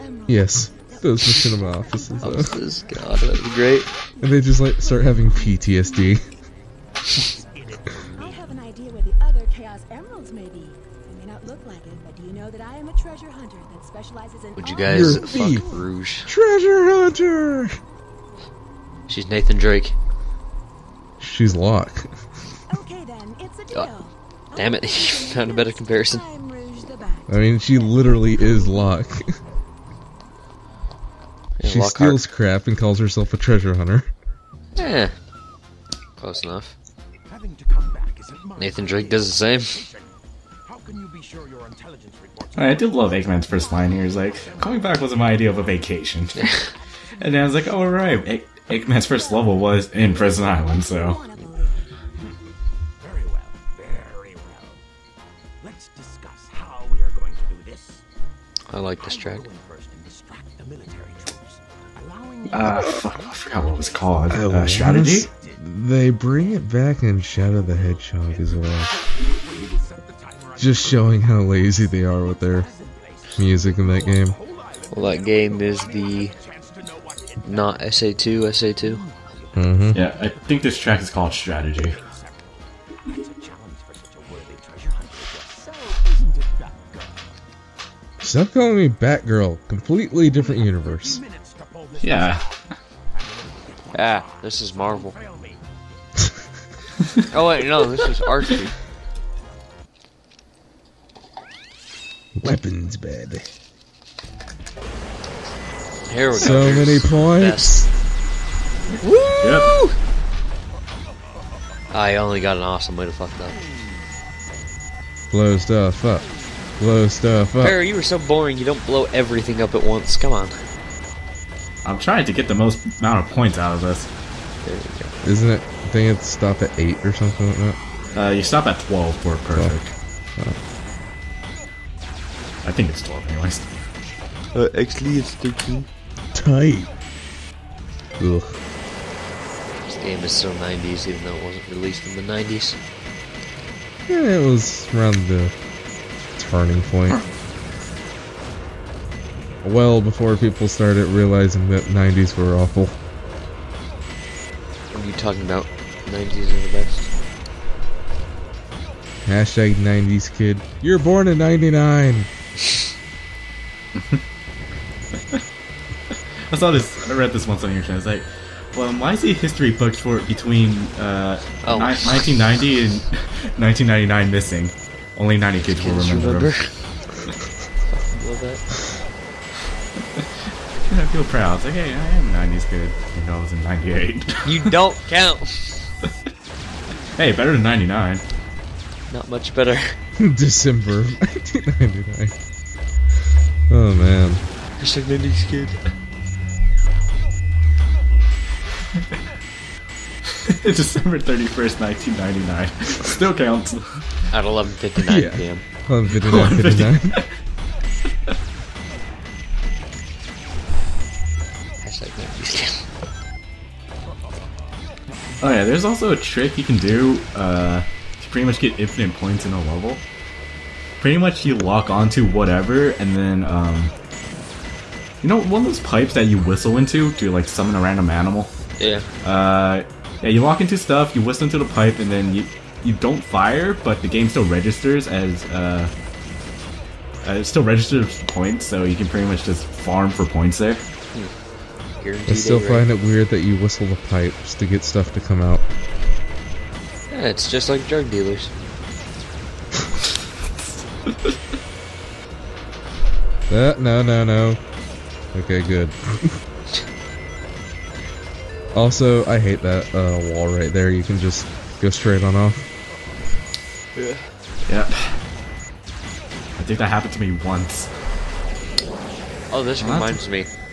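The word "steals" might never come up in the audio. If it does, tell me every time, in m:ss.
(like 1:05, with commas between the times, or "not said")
0:31.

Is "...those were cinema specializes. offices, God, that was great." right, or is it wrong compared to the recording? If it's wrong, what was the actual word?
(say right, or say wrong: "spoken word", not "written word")
wrong: "offices", not "specializes".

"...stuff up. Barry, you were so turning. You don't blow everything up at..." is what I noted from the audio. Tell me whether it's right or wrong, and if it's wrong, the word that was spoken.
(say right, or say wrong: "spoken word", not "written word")
wrong: "boring", not "turning".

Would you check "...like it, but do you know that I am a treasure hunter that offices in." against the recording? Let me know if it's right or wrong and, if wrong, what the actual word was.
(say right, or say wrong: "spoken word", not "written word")
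wrong: "specializes", not "offices".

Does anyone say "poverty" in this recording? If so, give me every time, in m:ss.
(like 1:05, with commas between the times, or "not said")
not said.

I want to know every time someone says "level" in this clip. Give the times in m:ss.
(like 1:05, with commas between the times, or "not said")
0:49, 3:39.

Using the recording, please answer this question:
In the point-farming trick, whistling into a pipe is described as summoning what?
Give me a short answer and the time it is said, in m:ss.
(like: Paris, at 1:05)
A random animal, at 3:47.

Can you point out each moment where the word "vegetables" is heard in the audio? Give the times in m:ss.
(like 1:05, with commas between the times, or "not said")
not said.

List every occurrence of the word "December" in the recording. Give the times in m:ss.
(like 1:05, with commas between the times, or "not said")
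3:10, 3:20.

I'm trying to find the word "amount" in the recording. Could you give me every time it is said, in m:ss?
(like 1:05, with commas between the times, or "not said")
2:03.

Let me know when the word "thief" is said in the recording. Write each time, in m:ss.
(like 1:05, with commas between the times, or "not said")
0:15.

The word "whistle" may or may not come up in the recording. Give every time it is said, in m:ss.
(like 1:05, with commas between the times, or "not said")
3:46, 3:51, 4:03.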